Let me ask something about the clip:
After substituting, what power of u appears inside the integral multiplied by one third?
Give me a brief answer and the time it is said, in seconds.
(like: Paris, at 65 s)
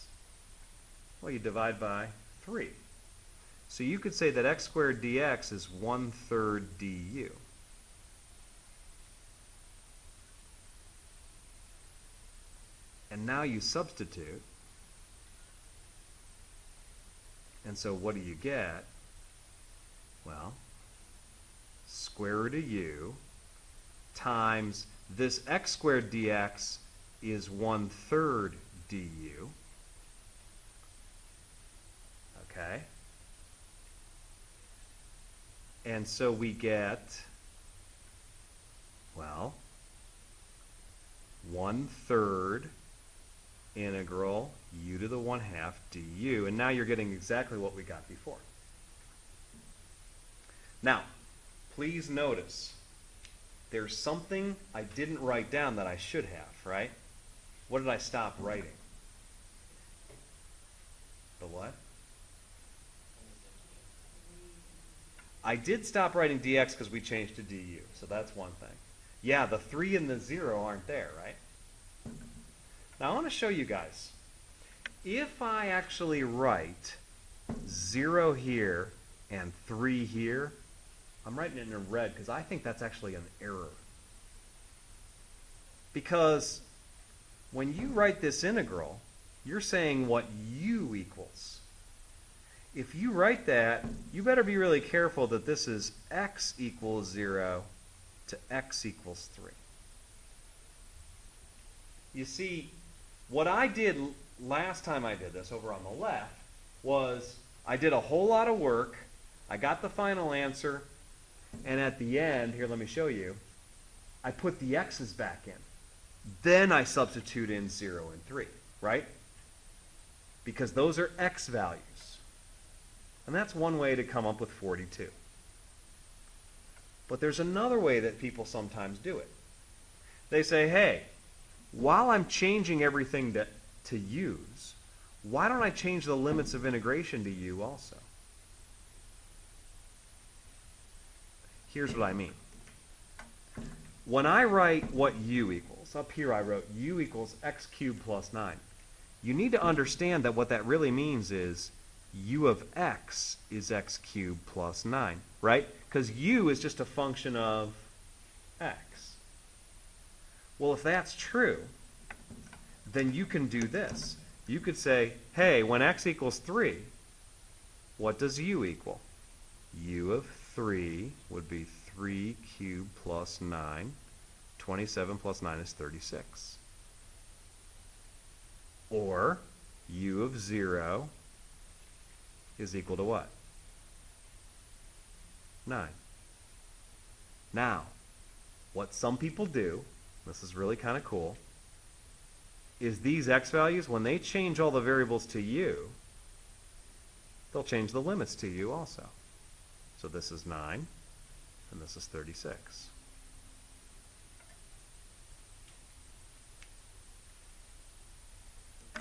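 1/2, at 44 s.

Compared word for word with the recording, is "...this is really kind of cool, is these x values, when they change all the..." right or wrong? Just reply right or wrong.
right.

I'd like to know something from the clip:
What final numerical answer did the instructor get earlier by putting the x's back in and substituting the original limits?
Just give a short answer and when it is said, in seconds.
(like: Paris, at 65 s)
42, at 124 s.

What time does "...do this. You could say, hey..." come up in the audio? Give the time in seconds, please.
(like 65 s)
163 s.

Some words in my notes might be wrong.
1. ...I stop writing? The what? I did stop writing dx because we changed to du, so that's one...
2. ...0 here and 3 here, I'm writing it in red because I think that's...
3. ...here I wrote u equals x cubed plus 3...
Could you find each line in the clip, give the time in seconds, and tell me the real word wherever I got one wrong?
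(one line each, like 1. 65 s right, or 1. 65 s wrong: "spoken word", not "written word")
1. 57 s right
2. 77 s right
3. 146 s wrong: "9", not "3".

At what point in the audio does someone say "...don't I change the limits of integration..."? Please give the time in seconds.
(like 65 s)
135 s.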